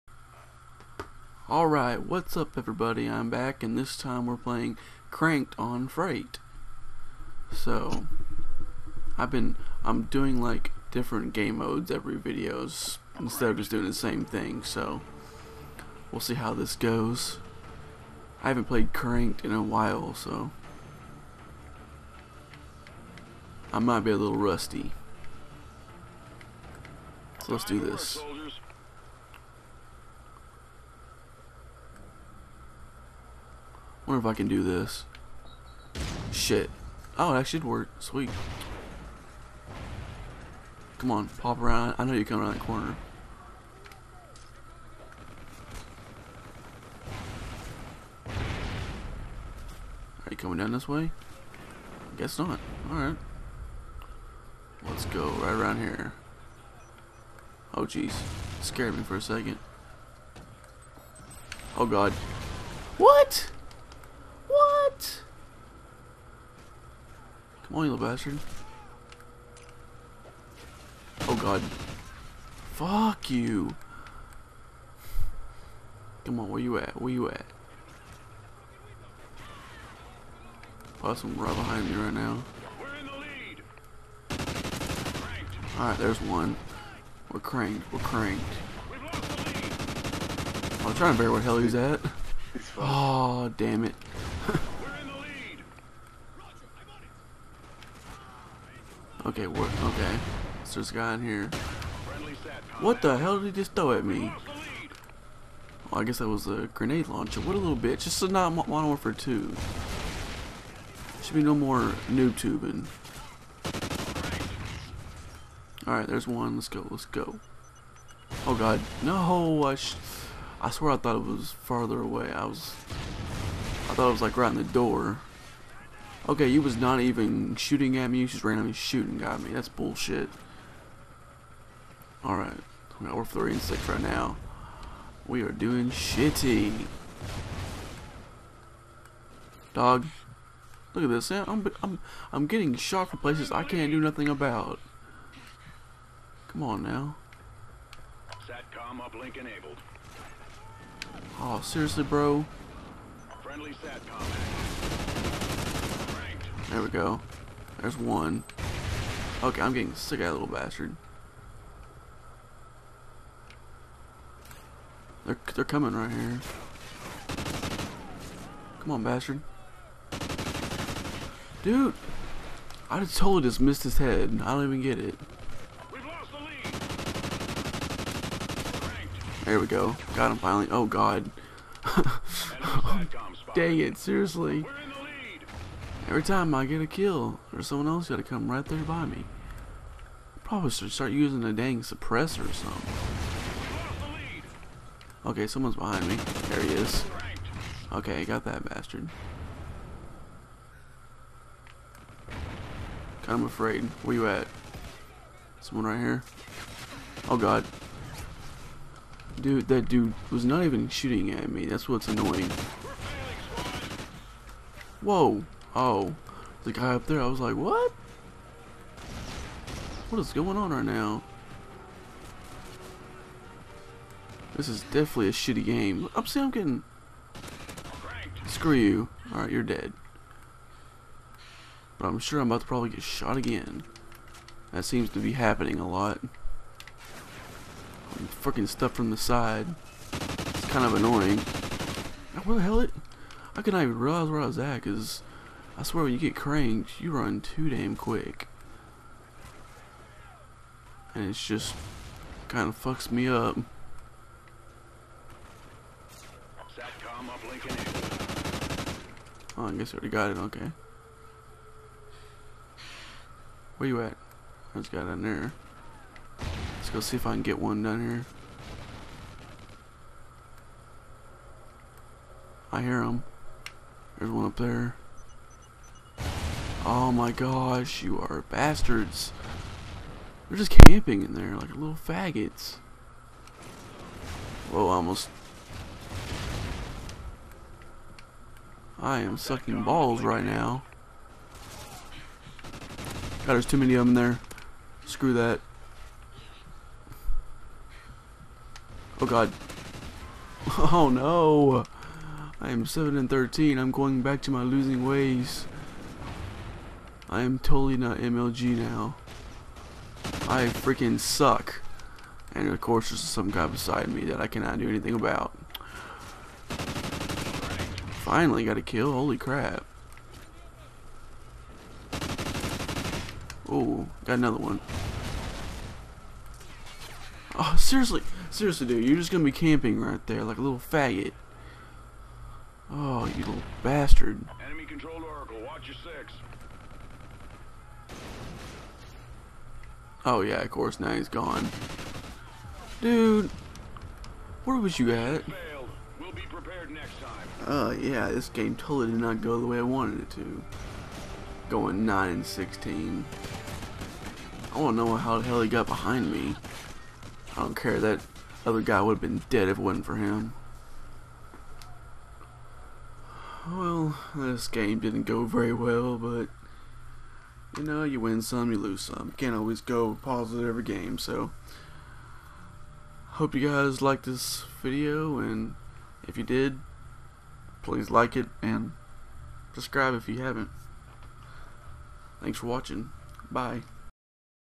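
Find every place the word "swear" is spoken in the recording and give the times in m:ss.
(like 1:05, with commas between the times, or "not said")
2:00, 4:05.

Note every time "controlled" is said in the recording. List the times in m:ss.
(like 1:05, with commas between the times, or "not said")
5:34.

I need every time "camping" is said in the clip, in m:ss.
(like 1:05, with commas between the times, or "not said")
4:40, 5:29.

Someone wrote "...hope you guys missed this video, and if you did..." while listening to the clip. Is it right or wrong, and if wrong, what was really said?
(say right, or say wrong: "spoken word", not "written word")
wrong: "liked", not "missed".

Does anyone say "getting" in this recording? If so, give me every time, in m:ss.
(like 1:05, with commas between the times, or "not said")
2:22, 2:39, 3:46.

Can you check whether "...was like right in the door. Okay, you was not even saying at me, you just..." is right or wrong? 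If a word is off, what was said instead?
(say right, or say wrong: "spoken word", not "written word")
wrong: "shooting", not "saying".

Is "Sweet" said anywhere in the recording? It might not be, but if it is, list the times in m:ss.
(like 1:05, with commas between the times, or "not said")
0:38.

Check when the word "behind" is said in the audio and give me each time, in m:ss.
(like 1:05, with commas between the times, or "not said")
1:21, 3:15, 5:55.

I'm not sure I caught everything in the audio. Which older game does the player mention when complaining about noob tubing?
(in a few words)
Modern Warfare 2.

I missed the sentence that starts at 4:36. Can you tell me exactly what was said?
Oh my gosh, you are bastards.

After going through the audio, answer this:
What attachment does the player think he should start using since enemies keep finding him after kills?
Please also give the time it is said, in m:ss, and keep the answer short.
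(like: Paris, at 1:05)
suppressor, at 3:11.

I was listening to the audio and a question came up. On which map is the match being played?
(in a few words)
Freight.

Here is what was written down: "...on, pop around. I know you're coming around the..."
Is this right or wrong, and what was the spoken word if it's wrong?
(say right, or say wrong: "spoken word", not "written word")
right.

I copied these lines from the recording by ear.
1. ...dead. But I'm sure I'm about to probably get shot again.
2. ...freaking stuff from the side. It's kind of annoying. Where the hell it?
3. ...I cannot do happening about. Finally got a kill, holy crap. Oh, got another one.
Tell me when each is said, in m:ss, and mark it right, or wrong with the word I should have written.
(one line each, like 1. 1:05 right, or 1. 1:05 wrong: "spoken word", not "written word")
1. 3:49 right
2. 3:58 right
3. 5:14 wrong: "anything", not "happening".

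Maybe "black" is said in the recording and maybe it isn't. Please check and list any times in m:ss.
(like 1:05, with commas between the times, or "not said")
not said.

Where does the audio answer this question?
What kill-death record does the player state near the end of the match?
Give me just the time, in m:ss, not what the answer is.
5:52.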